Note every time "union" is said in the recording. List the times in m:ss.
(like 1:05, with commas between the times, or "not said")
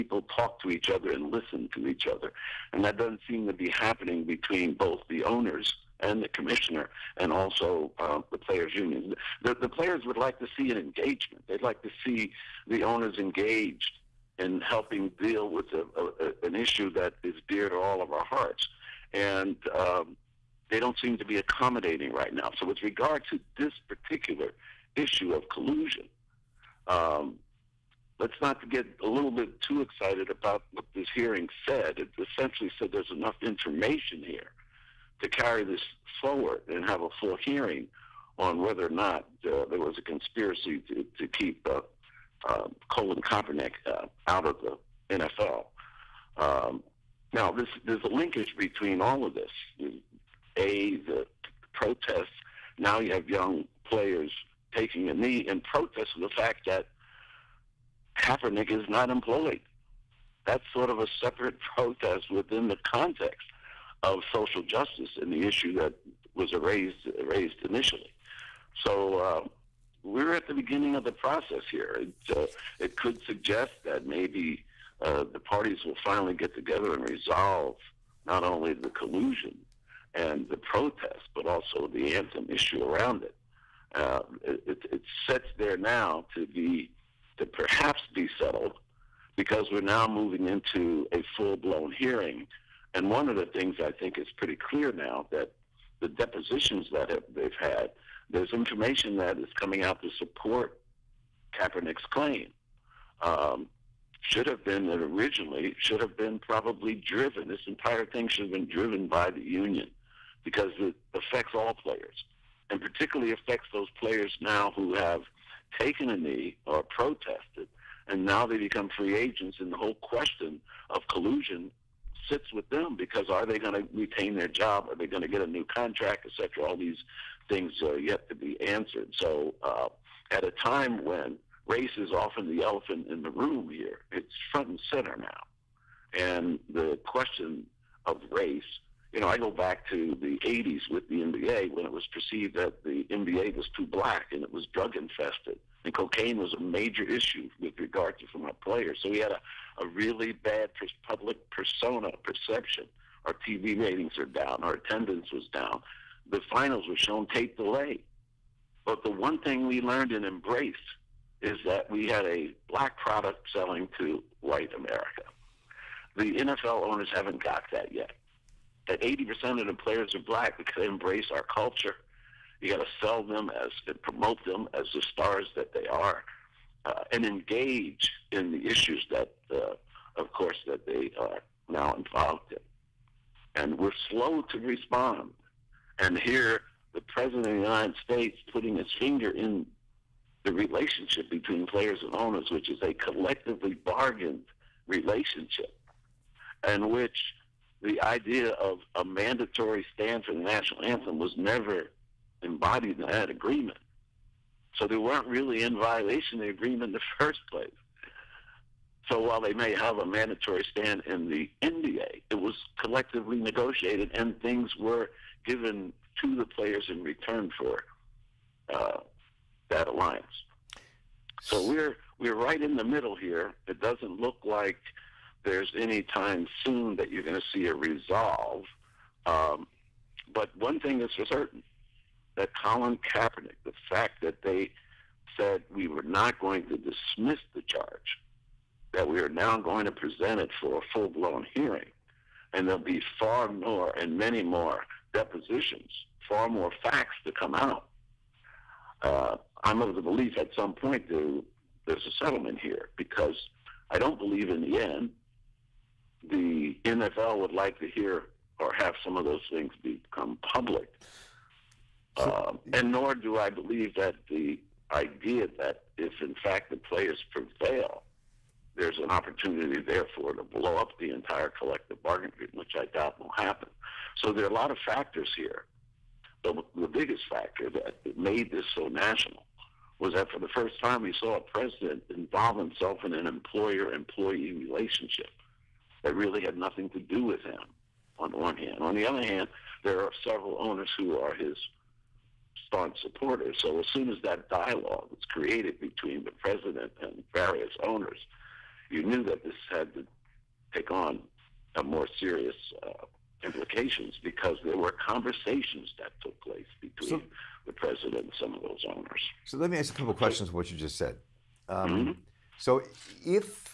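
0:08, 1:49.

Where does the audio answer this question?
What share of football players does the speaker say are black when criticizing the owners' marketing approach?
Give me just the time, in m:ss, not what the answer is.
2:49.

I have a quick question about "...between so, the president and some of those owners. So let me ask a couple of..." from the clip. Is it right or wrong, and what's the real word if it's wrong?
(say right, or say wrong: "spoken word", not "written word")
right.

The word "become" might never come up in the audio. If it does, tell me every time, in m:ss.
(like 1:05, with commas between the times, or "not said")
1:58, 4:19.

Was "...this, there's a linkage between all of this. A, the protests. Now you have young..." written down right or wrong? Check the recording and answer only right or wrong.
right.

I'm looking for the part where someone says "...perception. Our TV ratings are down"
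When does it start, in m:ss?
2:32.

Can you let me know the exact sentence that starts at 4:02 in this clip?
And there'll be far more and many more depositions, far more facts to come out.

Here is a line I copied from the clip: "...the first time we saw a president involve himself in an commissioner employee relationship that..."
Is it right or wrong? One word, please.
wrong.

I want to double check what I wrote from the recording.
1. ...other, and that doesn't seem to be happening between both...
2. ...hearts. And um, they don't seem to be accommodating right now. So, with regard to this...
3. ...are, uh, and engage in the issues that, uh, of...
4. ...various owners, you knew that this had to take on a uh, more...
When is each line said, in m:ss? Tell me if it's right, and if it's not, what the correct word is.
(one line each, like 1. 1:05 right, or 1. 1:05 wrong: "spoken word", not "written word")
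1. 0:02 right
2. 0:18 right
3. 2:55 right
4. 4:57 right.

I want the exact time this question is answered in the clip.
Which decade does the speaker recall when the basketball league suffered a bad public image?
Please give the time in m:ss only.
2:20.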